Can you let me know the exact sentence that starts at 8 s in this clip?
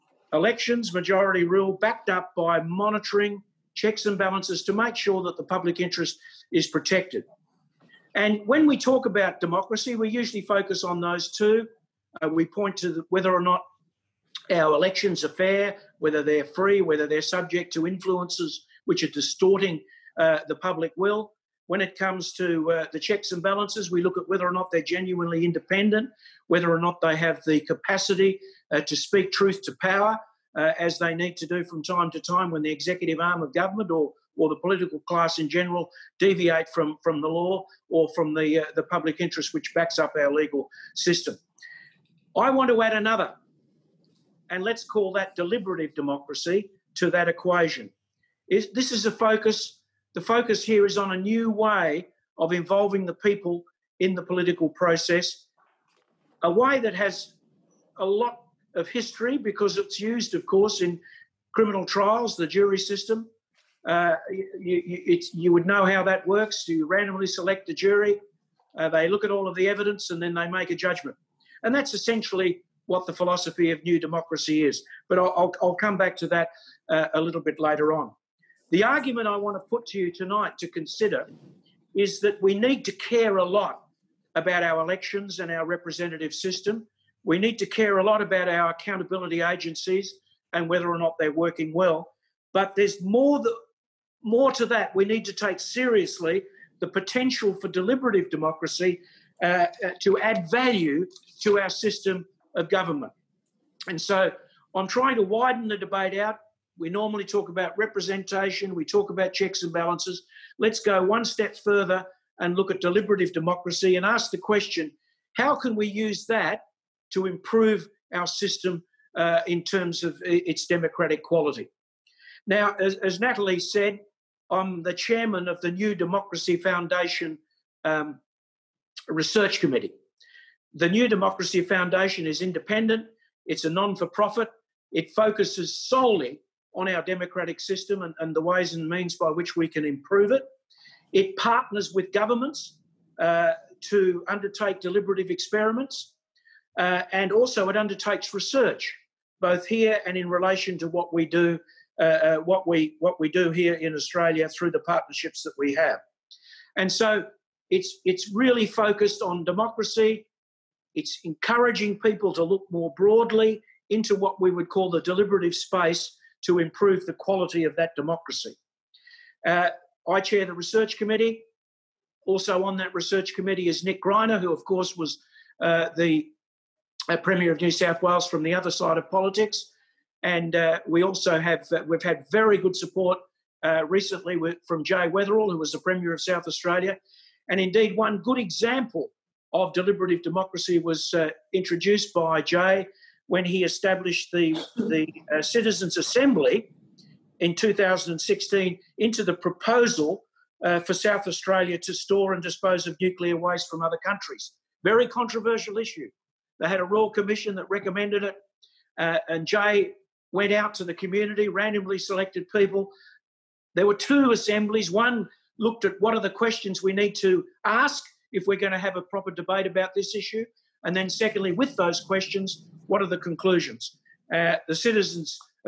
And when we talk about democracy, we usually focus on those two.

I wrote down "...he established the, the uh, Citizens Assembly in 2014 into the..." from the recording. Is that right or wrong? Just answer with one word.
wrong.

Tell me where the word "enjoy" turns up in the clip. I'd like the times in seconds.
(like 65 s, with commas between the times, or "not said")
not said.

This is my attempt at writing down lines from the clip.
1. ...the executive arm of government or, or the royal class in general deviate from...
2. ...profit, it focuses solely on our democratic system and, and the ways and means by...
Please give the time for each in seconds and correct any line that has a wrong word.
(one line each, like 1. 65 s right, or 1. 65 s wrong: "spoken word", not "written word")
1. 32 s wrong: "political", not "royal"
2. 134 s right.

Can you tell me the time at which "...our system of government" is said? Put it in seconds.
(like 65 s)
101 s.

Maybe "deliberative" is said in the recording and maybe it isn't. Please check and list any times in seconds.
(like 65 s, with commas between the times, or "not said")
45 s, 97 s, 112 s, 144 s, 165 s, 189 s.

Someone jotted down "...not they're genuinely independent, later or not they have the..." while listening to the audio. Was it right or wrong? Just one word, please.
wrong.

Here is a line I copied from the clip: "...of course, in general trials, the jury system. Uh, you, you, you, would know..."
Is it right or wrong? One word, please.
wrong.